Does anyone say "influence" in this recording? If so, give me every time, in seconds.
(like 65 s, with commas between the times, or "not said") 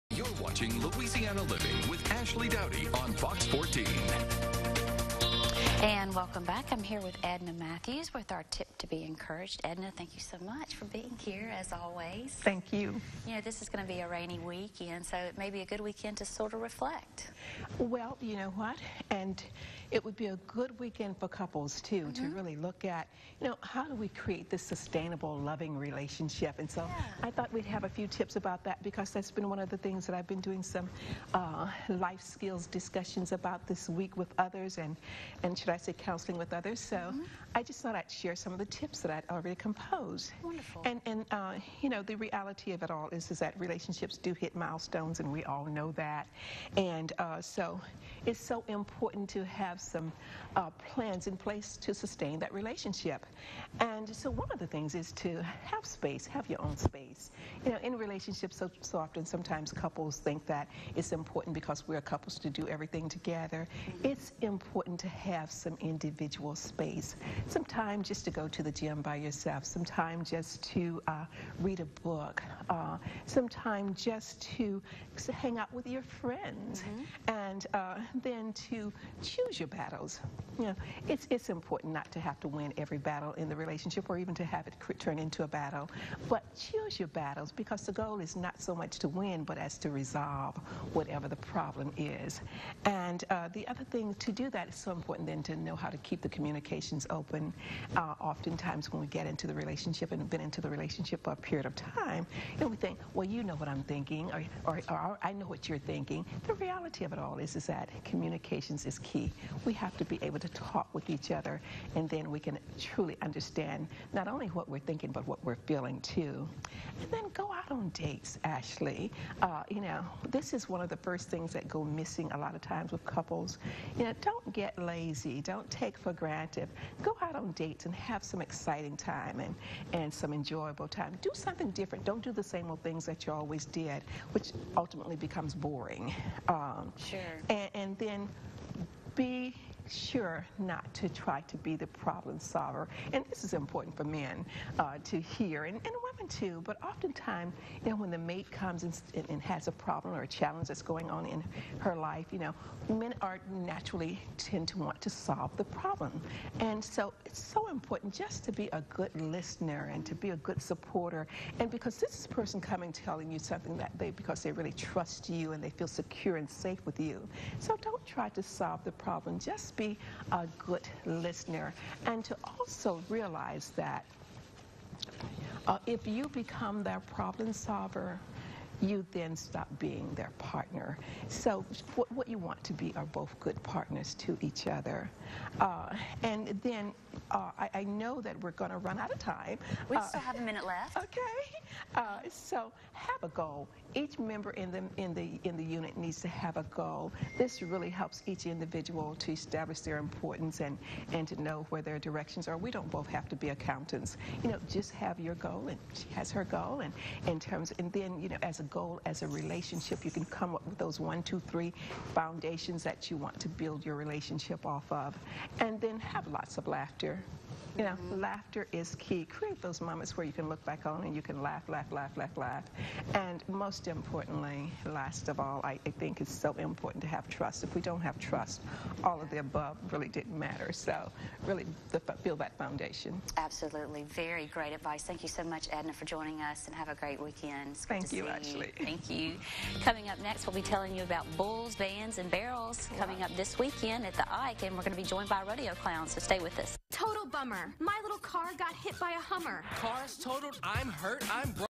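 not said.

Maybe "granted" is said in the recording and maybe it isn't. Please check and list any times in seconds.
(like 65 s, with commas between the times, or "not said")
126 s.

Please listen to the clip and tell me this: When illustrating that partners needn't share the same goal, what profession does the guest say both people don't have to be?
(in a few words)
Accountants.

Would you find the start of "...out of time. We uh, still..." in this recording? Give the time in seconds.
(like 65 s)
188 s.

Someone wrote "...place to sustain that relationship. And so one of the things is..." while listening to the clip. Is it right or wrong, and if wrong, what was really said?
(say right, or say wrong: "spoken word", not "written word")
right.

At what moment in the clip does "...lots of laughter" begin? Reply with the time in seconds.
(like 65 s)
216 s.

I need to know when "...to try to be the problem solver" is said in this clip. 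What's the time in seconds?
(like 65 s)
140 s.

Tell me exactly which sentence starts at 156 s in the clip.
And so it's so important just to be a good listener and to be a good supporter.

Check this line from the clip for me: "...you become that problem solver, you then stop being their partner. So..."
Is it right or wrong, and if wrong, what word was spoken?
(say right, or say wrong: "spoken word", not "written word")
right.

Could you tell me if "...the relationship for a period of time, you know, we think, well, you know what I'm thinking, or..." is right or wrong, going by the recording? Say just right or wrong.
right.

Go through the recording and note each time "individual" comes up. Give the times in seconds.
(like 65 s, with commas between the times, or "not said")
65 s, 198 s.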